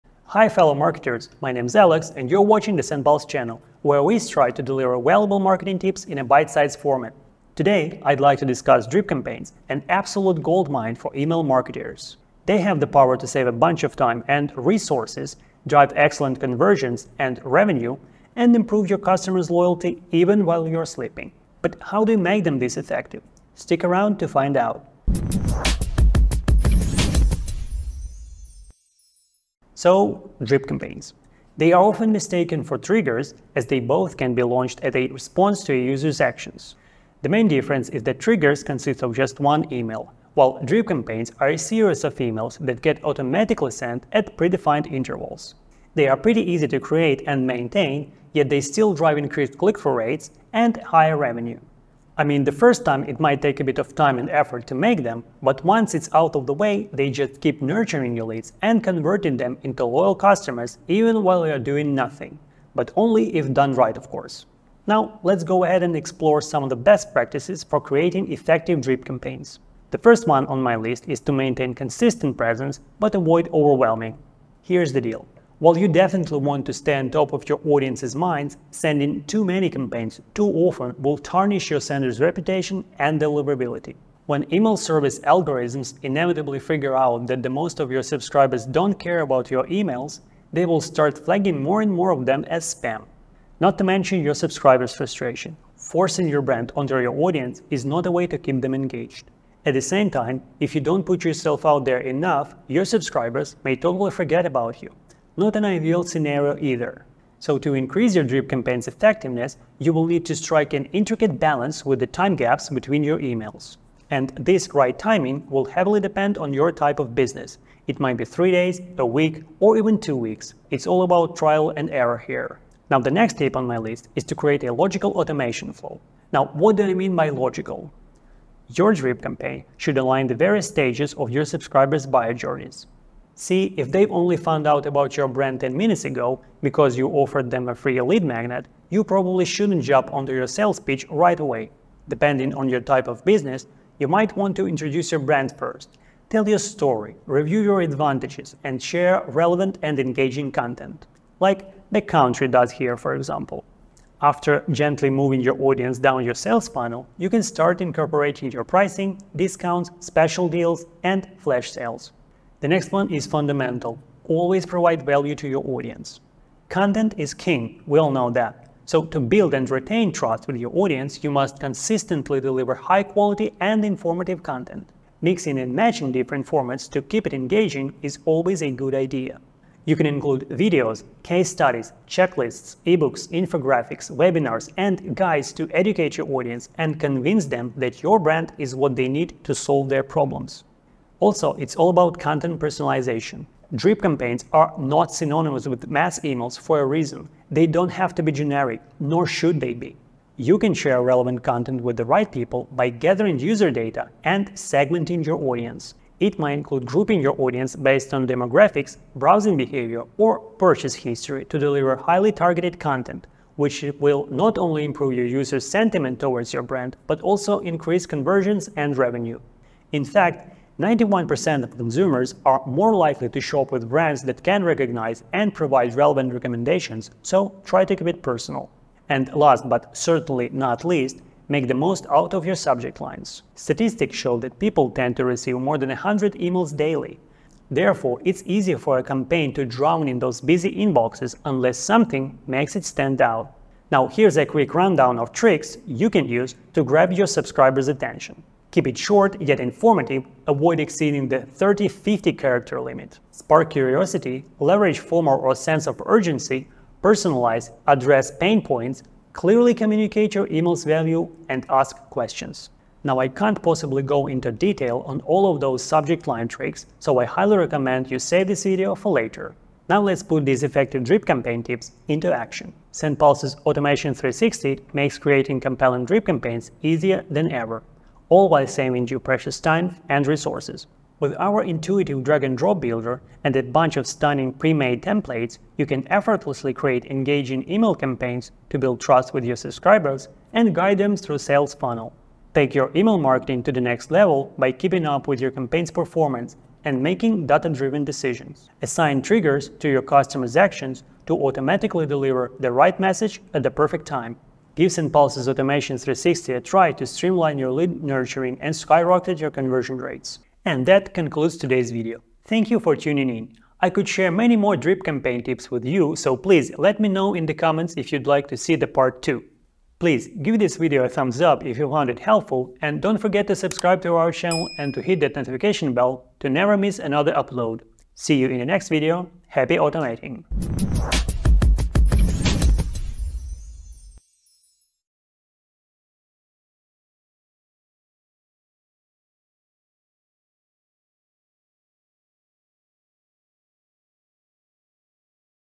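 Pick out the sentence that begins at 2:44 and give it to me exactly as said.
Always provide value to your audience.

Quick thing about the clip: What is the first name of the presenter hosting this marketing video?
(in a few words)
Alex.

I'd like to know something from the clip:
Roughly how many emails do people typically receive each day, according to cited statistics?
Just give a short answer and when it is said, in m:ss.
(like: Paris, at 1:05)
more than 100, at 3:55.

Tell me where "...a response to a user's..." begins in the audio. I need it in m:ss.
0:34.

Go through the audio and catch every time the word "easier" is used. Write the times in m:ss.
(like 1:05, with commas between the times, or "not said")
3:58, 4:36.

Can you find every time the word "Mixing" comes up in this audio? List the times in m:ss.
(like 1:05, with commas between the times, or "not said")
2:55.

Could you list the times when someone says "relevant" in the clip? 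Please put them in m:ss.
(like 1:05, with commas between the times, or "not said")
2:29, 3:21, 3:45.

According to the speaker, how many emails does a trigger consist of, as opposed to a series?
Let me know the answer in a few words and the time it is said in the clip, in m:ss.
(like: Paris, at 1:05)
1, at 0:39.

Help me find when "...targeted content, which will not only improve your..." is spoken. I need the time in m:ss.
3:32.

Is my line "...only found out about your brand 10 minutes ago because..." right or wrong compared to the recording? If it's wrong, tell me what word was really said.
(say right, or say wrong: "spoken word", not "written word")
right.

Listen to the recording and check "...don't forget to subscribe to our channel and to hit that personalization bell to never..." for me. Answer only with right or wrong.
wrong.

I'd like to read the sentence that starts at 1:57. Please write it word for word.
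It might be three days, a week, or even two weeks.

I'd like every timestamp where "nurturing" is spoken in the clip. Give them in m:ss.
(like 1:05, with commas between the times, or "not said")
0:57, 5:08.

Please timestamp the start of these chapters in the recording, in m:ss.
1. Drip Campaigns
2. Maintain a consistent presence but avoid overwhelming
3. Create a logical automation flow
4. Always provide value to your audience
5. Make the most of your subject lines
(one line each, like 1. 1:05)
1. 0:30
2. 1:10
3. 1:54
4. 2:46
5. 3:55.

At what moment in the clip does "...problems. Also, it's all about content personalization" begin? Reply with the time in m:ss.
3:10.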